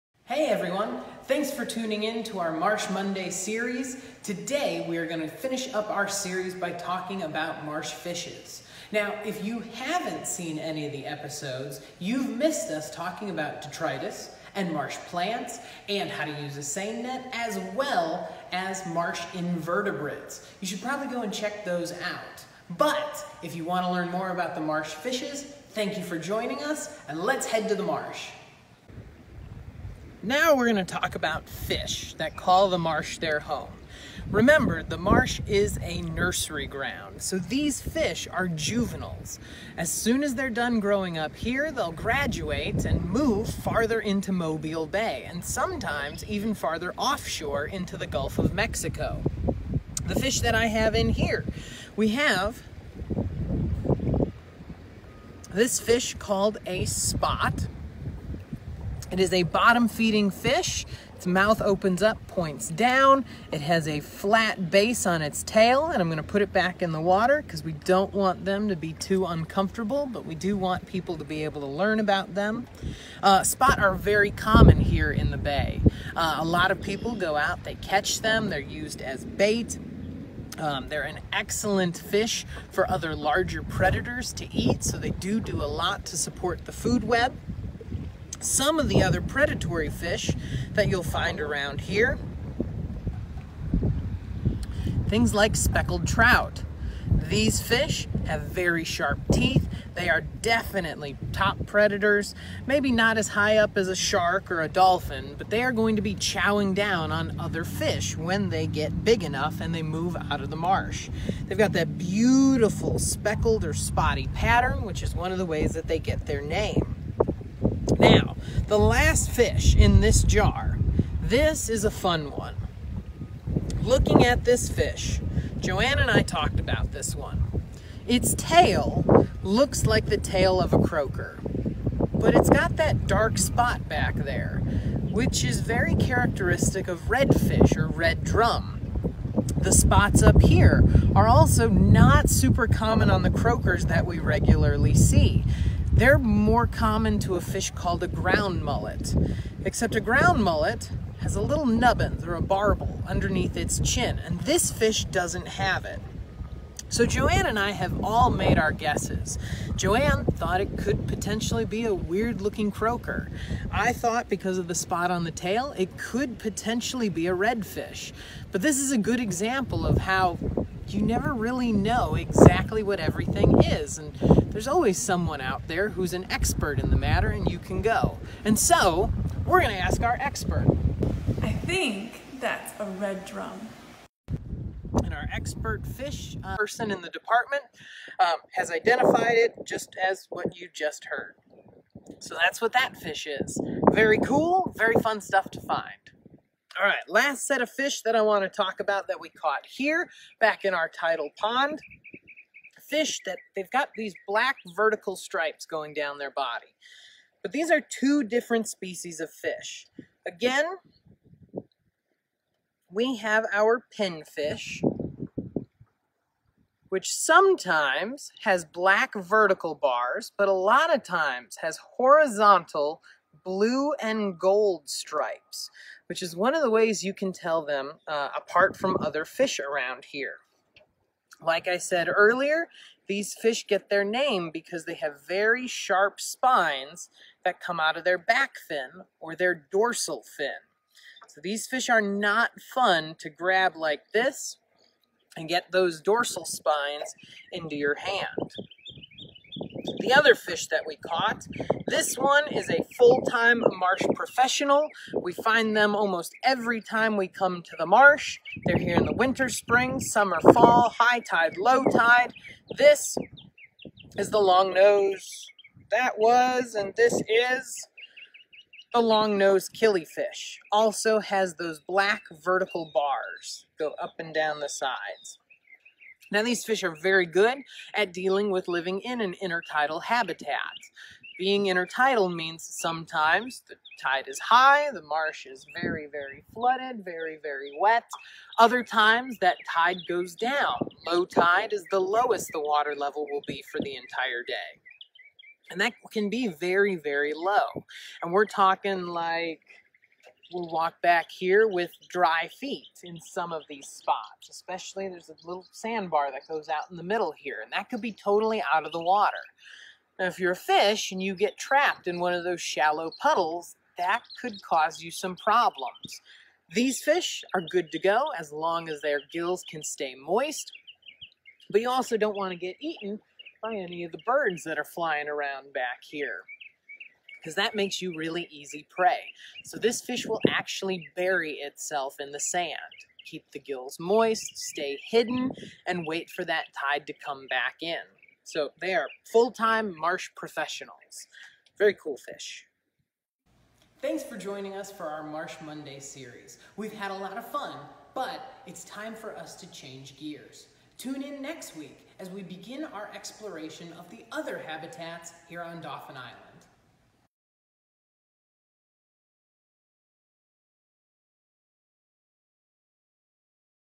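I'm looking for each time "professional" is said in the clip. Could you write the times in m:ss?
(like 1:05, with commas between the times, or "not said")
4:14, 5:40.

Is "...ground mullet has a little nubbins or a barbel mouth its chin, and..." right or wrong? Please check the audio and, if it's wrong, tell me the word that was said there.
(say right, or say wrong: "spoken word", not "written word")
wrong: "underneath", not "mouth".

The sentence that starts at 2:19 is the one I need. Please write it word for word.
The spots up here are also not super common on the croakers that we regularly see.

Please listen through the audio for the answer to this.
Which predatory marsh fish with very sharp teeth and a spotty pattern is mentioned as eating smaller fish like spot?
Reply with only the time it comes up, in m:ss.
1:35.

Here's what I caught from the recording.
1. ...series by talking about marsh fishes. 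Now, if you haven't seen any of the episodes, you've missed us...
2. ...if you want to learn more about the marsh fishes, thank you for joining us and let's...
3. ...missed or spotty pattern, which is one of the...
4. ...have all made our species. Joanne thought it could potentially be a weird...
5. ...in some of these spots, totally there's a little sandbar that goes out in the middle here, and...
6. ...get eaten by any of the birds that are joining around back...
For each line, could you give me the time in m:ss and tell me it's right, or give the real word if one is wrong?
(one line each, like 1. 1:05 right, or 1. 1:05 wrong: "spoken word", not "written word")
1. 0:06 right
2. 0:23 right
3. 1:52 wrong: "speckled", not "missed"
4. 2:37 wrong: "guesses", not "species"
5. 5:03 wrong: "especially", not "totally"
6. 5:22 wrong: "flying", not "joining".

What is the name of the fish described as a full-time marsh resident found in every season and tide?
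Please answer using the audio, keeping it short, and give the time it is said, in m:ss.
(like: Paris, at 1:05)
long nose killifish, at 4:29.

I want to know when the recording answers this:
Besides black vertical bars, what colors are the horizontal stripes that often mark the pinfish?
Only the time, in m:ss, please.
3:43.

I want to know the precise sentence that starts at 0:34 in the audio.
Remember, the marsh is a nursery ground, so these fish are juveniles.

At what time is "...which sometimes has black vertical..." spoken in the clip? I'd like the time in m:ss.
3:36.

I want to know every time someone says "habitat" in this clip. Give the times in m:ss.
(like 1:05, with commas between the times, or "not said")
4:40, 5:54.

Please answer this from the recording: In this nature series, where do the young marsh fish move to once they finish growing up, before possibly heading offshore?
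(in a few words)
Mobile Bay.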